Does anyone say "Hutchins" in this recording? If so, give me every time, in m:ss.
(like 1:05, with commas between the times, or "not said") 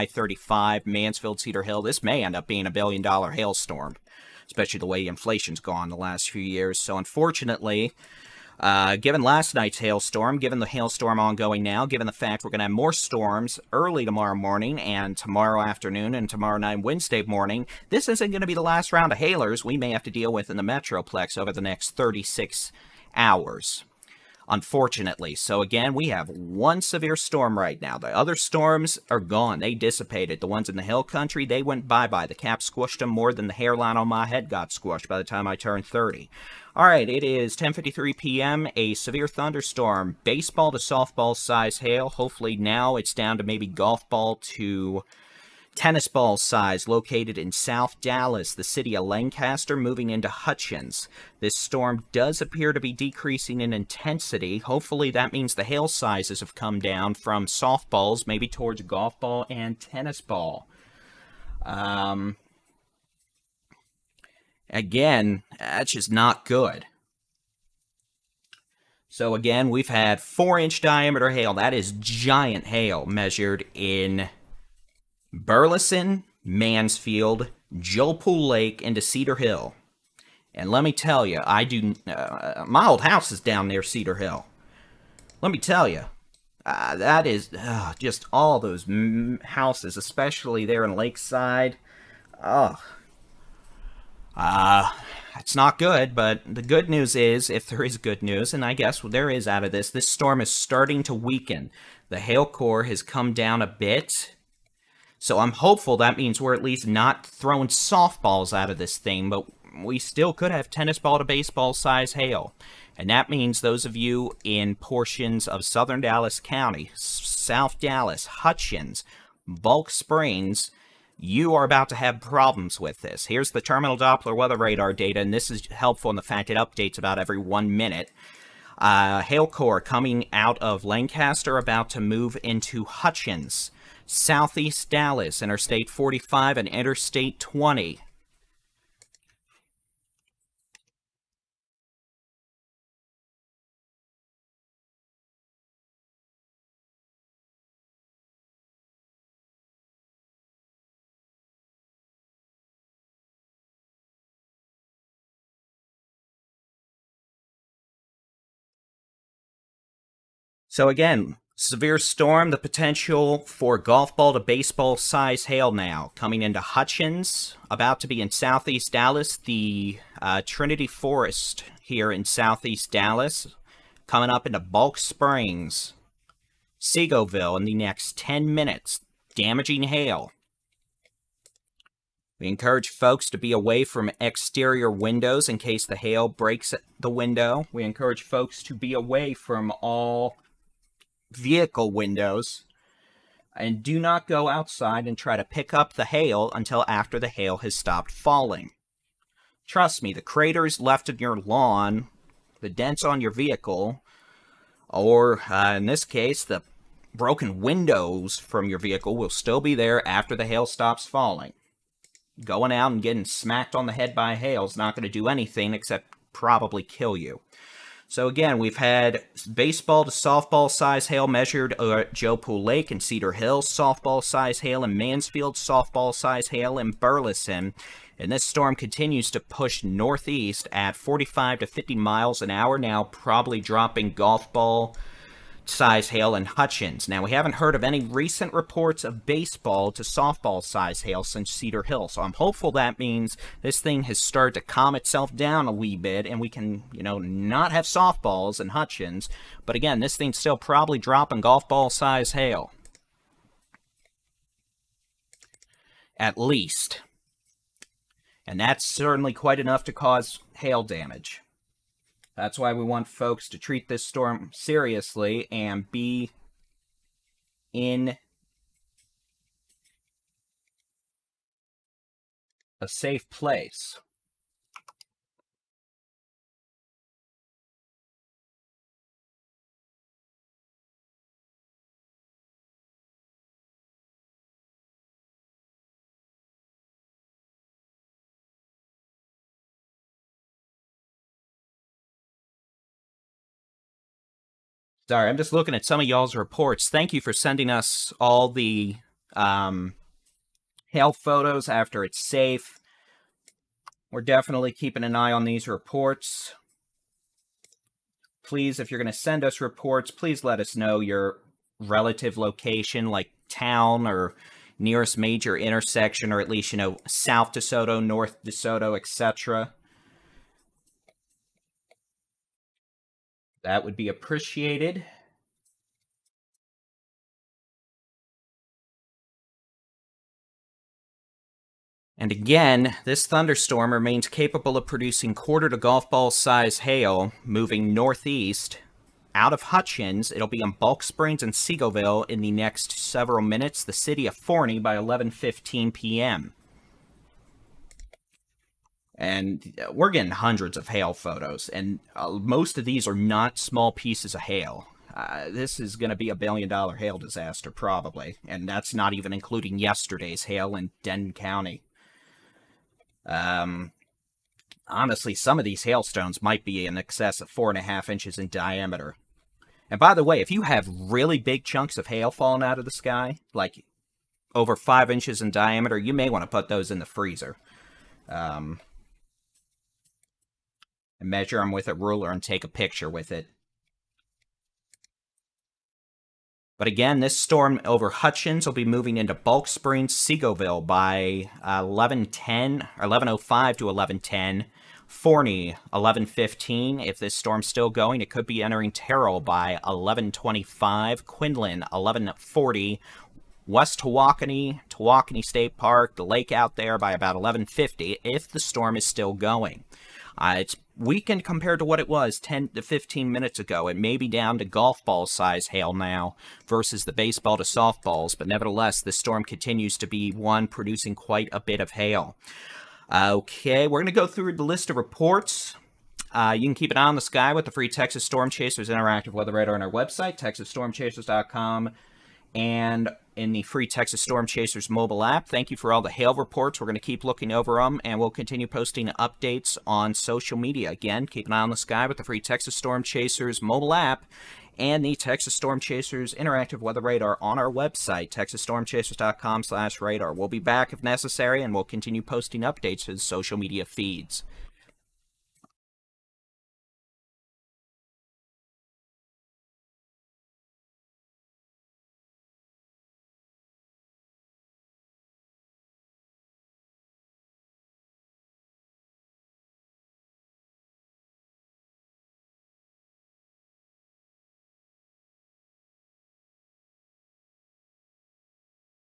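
0:50, 1:58, 2:12, 2:46, 3:56, 4:08, 5:39, 6:28.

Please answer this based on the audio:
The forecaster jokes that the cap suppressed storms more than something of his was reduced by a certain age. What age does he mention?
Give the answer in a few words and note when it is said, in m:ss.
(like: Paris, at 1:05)
30, at 0:35.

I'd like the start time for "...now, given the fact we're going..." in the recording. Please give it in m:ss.
0:11.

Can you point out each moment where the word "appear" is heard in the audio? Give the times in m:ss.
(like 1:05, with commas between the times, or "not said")
0:52.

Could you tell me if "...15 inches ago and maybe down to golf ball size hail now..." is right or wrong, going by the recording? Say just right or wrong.
wrong.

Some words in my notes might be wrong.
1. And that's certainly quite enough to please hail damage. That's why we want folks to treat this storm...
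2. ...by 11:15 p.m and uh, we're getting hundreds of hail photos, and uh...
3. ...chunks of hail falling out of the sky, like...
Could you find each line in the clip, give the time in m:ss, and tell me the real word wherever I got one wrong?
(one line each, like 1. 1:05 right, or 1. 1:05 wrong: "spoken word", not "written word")
1. 4:18 wrong: "cause", not "please"
2. 5:44 right
3. 6:11 right.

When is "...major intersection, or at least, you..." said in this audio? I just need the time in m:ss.
5:15.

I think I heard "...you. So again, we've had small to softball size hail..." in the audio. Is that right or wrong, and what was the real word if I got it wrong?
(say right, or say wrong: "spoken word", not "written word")
wrong: "baseball", not "small".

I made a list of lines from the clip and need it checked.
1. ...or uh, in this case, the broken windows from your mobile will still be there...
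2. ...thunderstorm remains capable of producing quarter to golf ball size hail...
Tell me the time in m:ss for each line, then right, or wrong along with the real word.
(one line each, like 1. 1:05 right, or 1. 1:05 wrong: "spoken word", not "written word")
1. 3:24 wrong: "vehicle", not "mobile"
2. 5:33 right.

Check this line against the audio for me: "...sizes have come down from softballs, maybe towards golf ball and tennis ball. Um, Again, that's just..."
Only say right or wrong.
right.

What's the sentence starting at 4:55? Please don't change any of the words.
Sorry, I'm just looking at some of y'all's reports.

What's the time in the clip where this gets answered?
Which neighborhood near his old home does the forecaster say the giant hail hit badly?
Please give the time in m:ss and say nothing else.
1:30.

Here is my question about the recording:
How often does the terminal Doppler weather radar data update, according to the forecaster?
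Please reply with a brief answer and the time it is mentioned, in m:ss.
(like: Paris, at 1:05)
About every one minute, at 2:06.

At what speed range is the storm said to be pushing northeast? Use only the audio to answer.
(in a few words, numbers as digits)
45 to 50 mph.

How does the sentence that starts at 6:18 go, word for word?
Um, and measure them with a ruler and take a picture with it.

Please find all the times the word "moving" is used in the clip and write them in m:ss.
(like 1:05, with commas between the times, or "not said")
0:49, 5:37, 6:28.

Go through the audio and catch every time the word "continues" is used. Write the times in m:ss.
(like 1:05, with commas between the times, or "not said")
3:48, 6:59, 7:18, 7:31.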